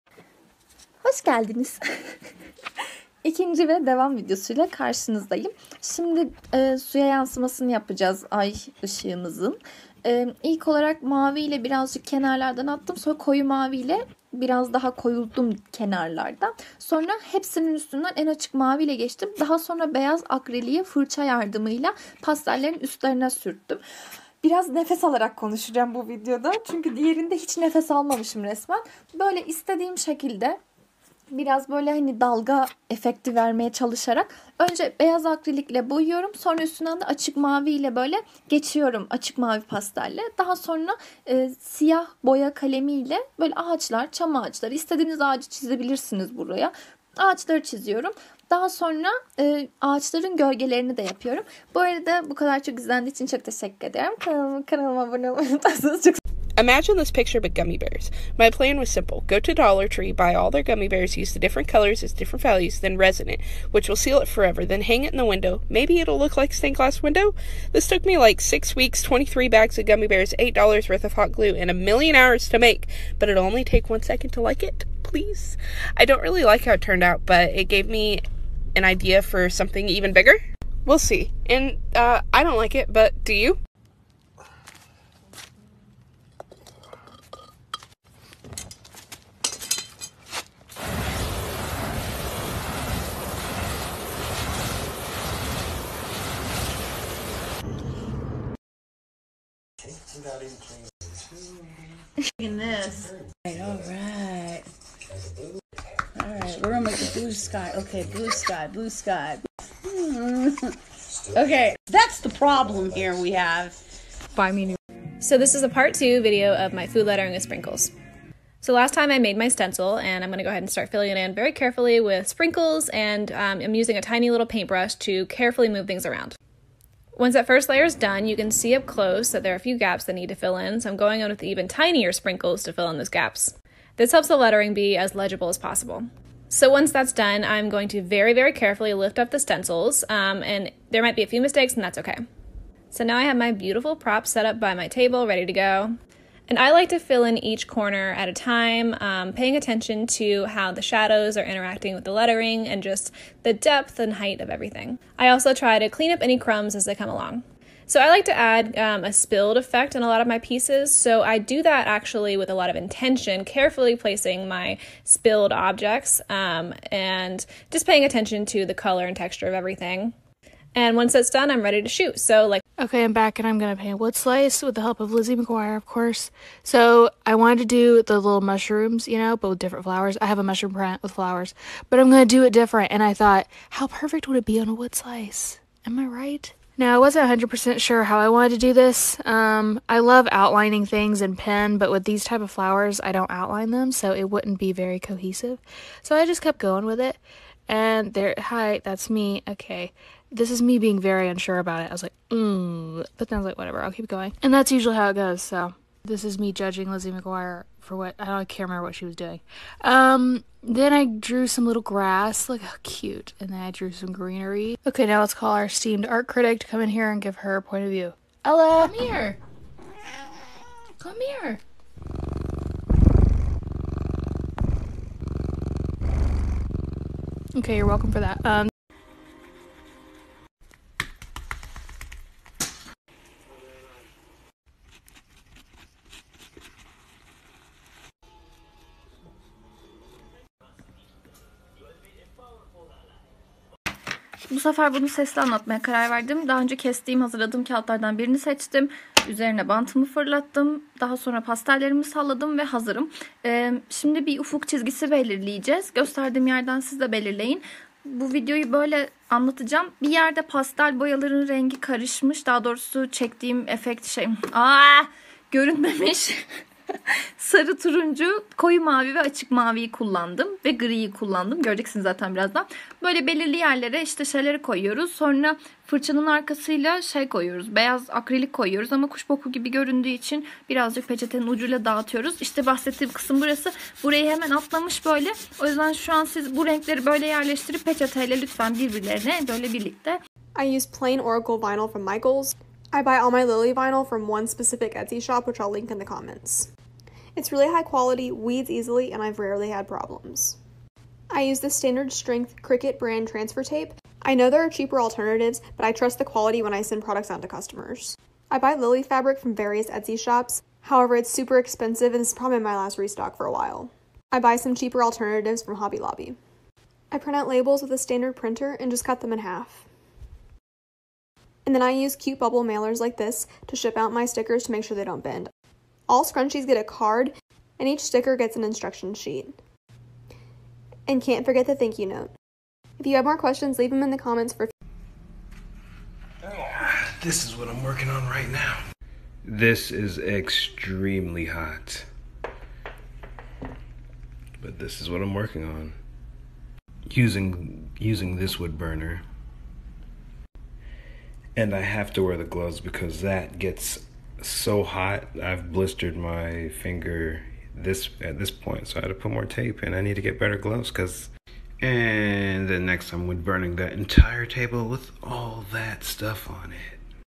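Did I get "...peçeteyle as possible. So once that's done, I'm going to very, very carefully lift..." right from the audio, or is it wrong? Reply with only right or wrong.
wrong.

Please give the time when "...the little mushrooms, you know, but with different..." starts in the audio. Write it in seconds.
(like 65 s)
178 s.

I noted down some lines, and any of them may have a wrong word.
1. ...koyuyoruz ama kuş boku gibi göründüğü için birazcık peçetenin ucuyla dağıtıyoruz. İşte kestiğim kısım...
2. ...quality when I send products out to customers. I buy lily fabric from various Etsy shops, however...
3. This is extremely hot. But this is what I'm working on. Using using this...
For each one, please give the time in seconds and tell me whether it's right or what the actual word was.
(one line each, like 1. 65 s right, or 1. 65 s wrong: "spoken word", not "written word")
1. 278 s wrong: "bahsettiğim", not "kestiğim"
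2. 306 s right
3. 339 s right.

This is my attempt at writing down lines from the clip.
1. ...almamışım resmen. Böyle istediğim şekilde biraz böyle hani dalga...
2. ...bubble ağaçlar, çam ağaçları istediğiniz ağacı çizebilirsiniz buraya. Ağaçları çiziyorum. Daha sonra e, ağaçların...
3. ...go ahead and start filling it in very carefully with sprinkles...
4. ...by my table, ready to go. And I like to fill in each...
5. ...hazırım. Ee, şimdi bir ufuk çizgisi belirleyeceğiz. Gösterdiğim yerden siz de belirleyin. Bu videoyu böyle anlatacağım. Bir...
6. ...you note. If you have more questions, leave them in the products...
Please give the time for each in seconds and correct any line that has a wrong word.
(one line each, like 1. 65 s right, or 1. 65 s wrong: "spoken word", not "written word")
1. 27 s right
2. 43 s wrong: "böyle", not "bubble"
3. 120 s right
4. 144 s right
5. 252 s right
6. 331 s wrong: "comments", not "products".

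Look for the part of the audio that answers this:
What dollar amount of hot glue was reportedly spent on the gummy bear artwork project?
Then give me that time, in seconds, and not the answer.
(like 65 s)
70 s.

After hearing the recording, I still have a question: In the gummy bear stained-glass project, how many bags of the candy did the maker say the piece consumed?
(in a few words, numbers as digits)
23.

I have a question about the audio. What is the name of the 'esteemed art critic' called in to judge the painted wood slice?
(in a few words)
Ella.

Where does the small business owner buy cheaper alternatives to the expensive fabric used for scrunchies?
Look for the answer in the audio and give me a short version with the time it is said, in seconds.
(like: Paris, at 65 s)
Hobby Lobby, at 315 s.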